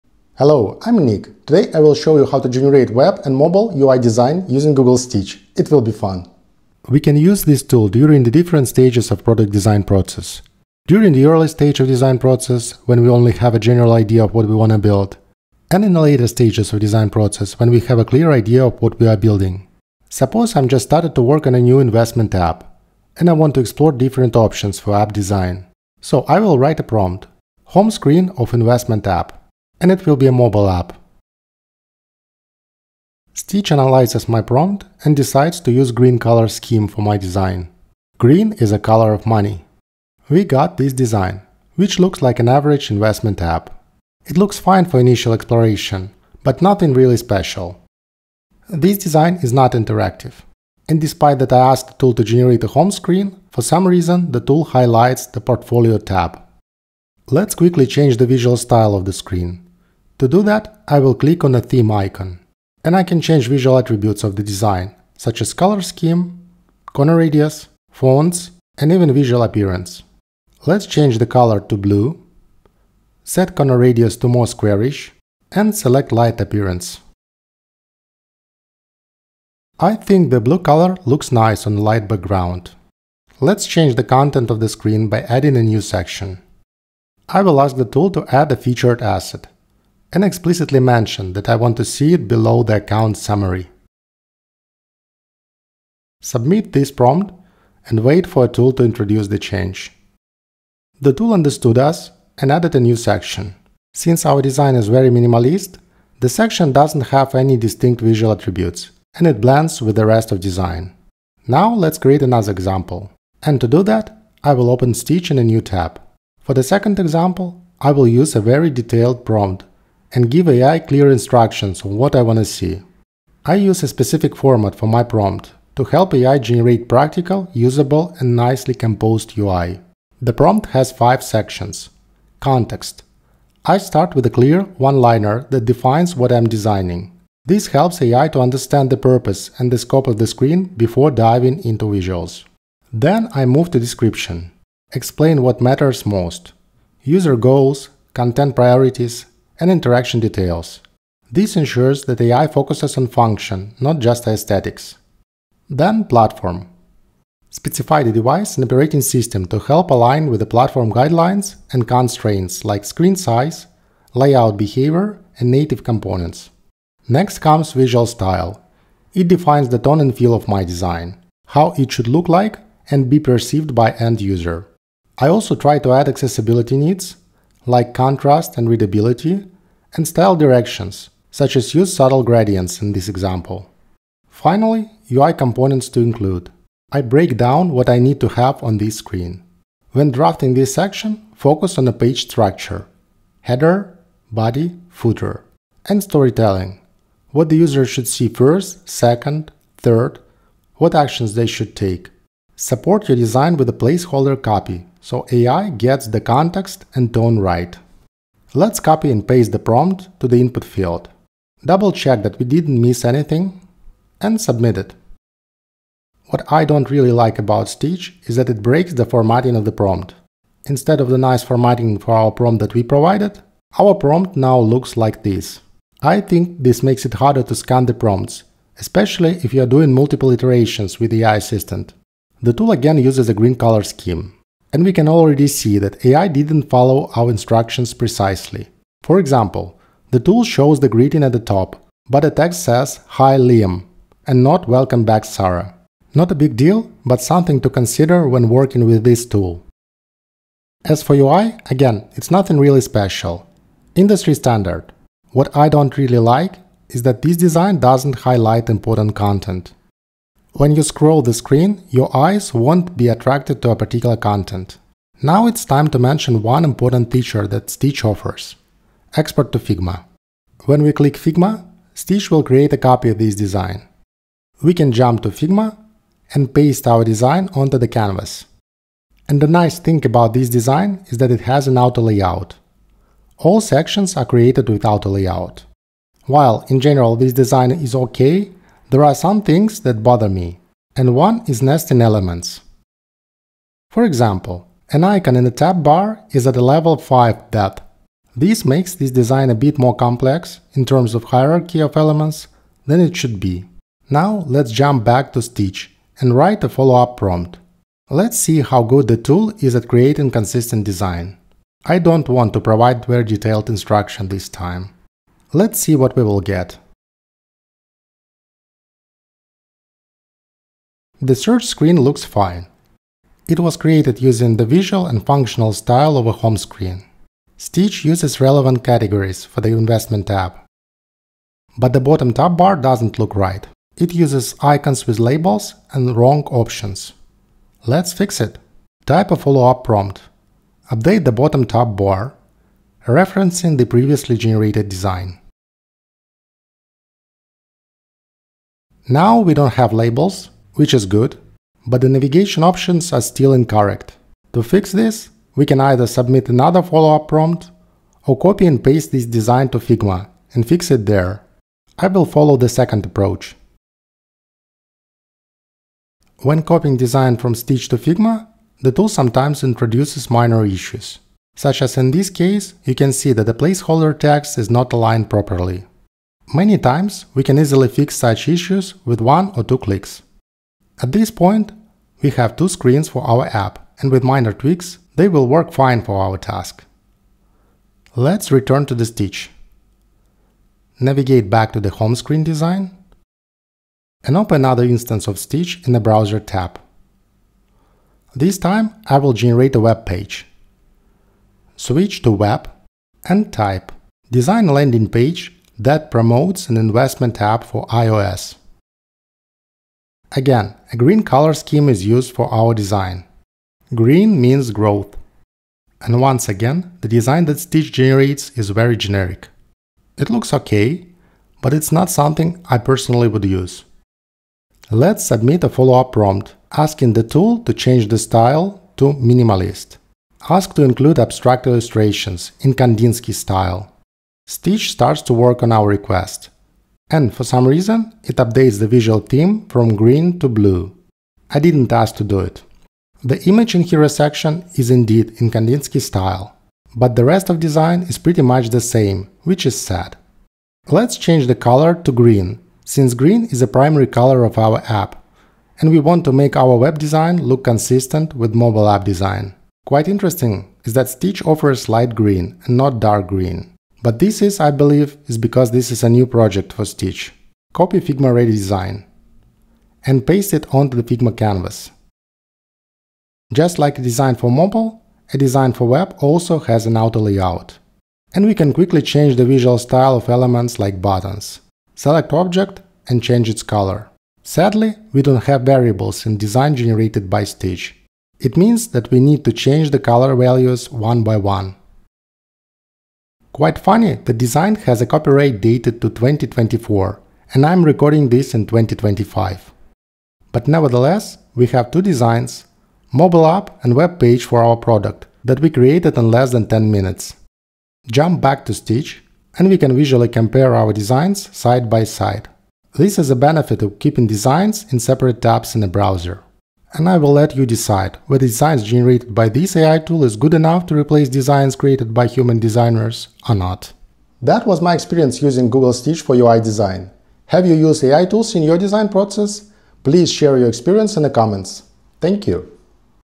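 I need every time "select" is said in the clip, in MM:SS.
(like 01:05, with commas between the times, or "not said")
01:15, 08:01.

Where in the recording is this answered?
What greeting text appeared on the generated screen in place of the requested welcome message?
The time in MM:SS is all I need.
04:03.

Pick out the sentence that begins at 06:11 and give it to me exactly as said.
Such as in this case, you can see that the placeholder text is not aligned properly.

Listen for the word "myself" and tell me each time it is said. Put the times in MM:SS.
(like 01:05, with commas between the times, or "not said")
not said.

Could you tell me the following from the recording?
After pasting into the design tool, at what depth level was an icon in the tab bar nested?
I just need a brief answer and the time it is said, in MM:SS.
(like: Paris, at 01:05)
Level 5, at 04:56.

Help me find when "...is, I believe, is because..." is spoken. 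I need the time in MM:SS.
07:44.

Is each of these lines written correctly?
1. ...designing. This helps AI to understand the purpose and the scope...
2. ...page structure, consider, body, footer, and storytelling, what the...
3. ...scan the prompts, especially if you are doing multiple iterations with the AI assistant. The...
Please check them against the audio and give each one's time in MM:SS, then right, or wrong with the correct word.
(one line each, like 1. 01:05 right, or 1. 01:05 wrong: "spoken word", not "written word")
1. 02:16 right
2. 03:11 wrong: "header", not "consider"
3. 03:47 right.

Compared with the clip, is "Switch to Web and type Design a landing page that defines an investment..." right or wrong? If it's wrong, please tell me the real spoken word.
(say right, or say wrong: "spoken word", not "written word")
wrong: "promotes", not "defines".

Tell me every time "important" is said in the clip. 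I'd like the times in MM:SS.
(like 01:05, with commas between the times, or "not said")
04:18, 04:26.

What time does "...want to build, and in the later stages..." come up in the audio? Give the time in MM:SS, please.
00:14.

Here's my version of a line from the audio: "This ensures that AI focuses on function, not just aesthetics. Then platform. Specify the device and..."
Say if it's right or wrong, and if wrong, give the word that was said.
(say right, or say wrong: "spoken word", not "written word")
right.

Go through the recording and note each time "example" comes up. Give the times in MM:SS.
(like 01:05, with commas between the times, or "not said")
01:52, 01:56, 03:03, 03:59, 04:54.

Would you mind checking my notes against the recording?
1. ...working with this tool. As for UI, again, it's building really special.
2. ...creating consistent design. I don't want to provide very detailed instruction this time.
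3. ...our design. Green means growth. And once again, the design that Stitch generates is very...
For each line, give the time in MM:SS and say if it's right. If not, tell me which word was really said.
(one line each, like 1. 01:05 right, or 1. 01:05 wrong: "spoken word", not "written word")
1. 04:08 wrong: "nothing", not "building"
2. 05:09 right
3. 06:52 right.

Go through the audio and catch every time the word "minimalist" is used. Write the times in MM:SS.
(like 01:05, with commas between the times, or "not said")
01:45, 07:09.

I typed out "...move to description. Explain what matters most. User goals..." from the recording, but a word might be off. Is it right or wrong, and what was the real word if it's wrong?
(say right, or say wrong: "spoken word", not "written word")
right.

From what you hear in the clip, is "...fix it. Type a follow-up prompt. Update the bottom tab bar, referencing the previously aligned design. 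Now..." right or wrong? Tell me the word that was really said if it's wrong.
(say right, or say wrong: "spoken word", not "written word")
wrong: "generated", not "aligned".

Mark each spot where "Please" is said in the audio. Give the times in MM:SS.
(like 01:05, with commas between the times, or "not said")
08:50.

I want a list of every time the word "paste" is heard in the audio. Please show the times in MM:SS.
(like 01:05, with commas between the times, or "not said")
03:29, 04:36, 05:58, 07:50.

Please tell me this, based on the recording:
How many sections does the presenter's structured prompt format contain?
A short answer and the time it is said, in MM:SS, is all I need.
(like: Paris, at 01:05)
5, at 02:10.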